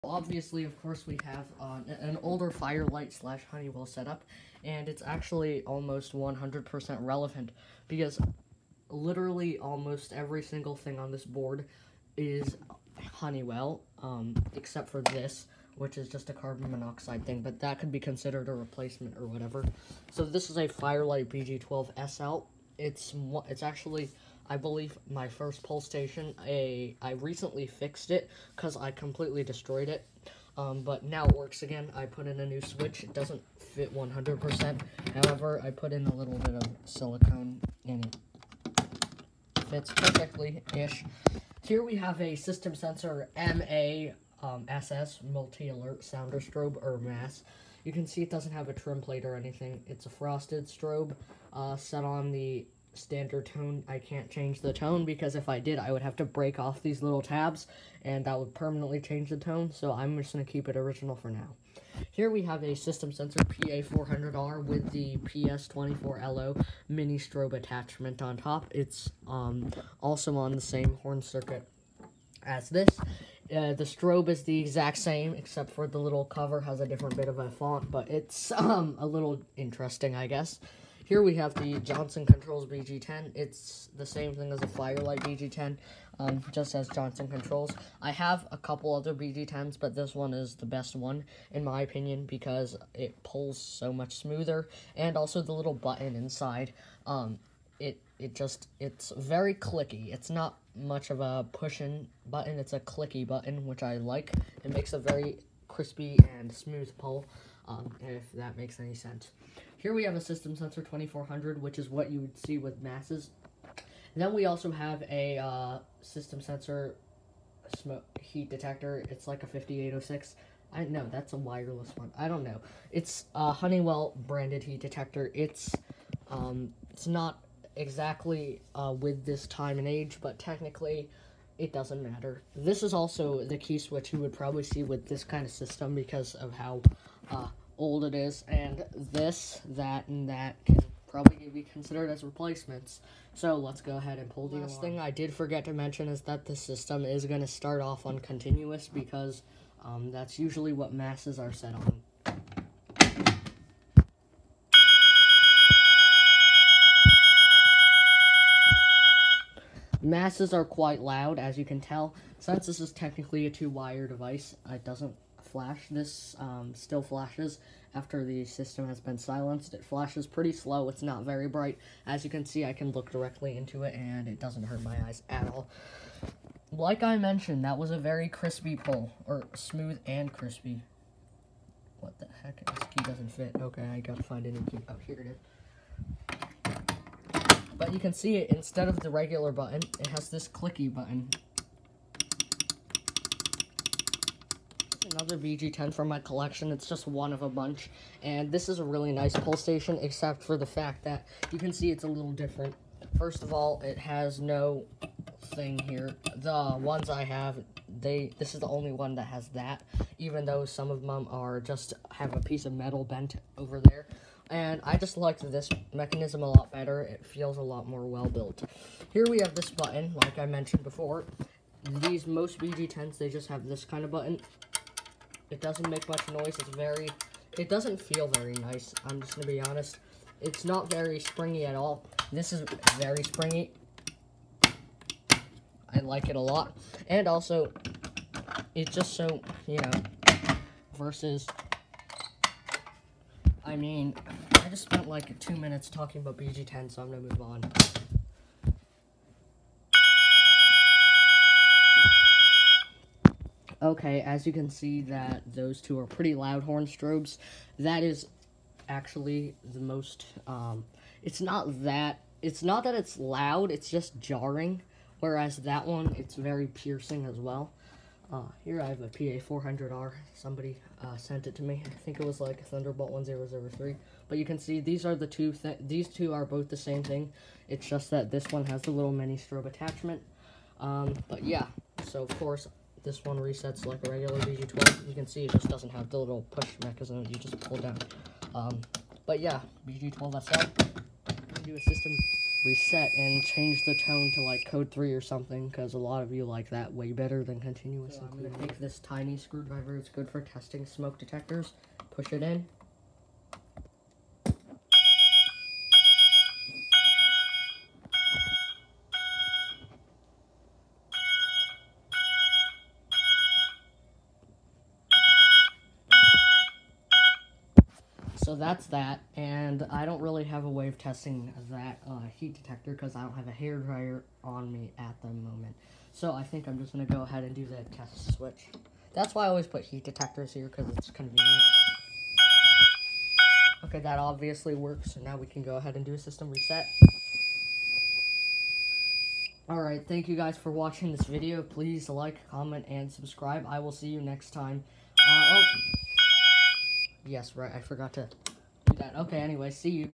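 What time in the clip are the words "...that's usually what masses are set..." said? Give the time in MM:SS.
02:30.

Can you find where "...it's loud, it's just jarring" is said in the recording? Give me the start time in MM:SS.
04:22.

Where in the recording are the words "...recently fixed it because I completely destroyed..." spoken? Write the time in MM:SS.
00:27.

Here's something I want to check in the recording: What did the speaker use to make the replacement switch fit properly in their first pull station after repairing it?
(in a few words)
silicone.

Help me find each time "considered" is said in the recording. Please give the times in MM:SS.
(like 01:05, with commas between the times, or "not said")
00:17, 02:21.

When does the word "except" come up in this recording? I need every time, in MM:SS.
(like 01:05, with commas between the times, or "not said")
00:14, 01:15, 03:20.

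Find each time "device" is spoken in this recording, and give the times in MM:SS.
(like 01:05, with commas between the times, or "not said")
02:44.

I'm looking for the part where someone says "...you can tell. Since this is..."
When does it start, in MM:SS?
02:41.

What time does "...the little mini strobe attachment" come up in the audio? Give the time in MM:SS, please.
04:38.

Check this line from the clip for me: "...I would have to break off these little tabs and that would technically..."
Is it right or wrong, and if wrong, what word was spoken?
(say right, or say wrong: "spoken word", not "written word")
wrong: "permanently", not "technically".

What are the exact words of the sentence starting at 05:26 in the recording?
So I think I'm just going to go ahead and do the test switch.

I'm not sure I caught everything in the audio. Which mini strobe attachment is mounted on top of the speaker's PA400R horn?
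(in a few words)
PS24LO.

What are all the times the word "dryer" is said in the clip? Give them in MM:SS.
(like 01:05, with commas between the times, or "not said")
05:23.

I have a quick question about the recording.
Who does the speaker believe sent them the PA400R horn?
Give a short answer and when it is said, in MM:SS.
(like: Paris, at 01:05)
Thunderbolt 1003, at 04:32.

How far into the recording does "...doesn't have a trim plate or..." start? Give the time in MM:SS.
00:48.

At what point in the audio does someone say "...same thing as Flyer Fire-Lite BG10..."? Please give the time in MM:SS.
01:24.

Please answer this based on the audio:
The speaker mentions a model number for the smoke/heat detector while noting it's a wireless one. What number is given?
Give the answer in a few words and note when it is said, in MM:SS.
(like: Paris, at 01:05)
5806, at 01:59.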